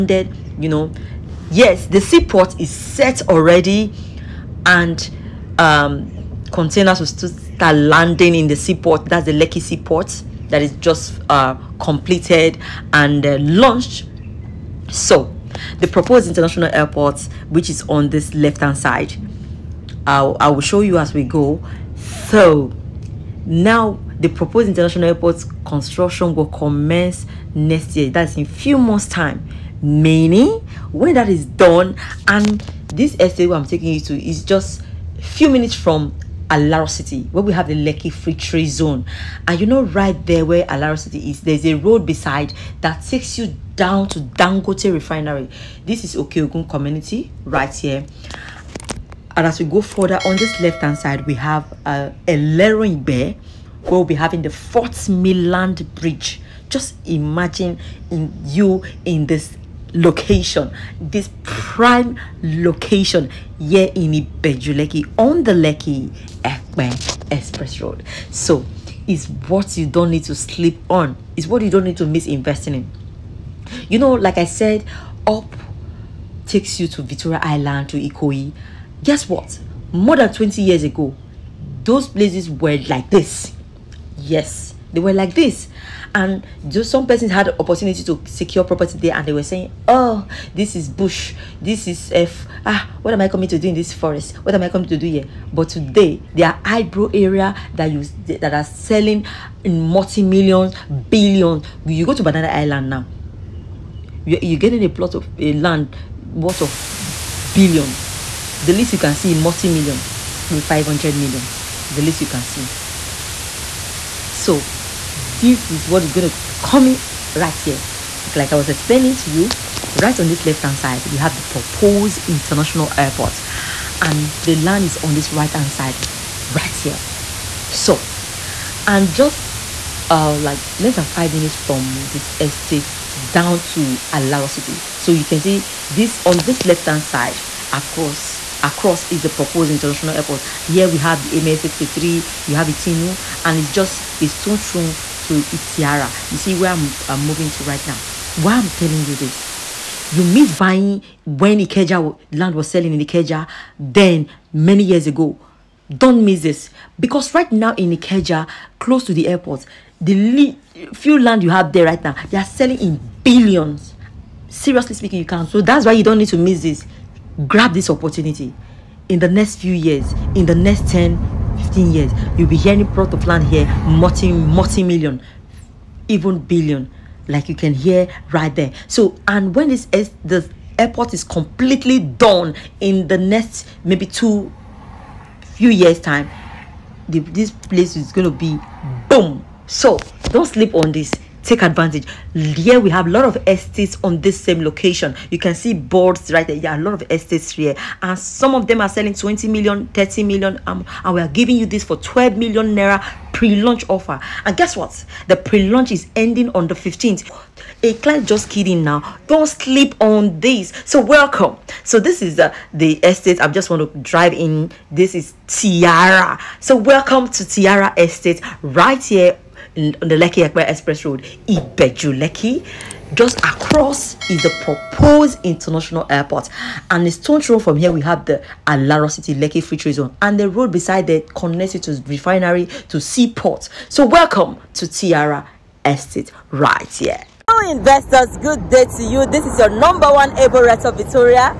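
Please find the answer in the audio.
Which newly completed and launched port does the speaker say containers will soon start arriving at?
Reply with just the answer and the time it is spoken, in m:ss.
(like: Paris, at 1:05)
Lekki seaport, at 0:09.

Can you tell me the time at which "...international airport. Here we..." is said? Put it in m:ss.
2:19.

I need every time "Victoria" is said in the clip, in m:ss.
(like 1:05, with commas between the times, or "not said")
1:17, 4:00.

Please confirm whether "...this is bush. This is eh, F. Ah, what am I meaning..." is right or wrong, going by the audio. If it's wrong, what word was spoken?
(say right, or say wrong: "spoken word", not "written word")
wrong: "coming", not "meaning".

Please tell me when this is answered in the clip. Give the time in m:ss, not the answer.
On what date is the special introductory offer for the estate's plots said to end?
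3:26.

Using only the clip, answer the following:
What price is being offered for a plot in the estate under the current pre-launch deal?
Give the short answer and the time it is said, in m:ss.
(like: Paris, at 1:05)
12 million naira, at 3:21.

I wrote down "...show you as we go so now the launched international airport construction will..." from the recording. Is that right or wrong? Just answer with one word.
wrong.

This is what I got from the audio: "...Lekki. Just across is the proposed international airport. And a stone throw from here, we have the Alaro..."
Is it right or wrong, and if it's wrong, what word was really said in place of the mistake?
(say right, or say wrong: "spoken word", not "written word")
right.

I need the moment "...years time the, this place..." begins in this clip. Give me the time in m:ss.
3:05.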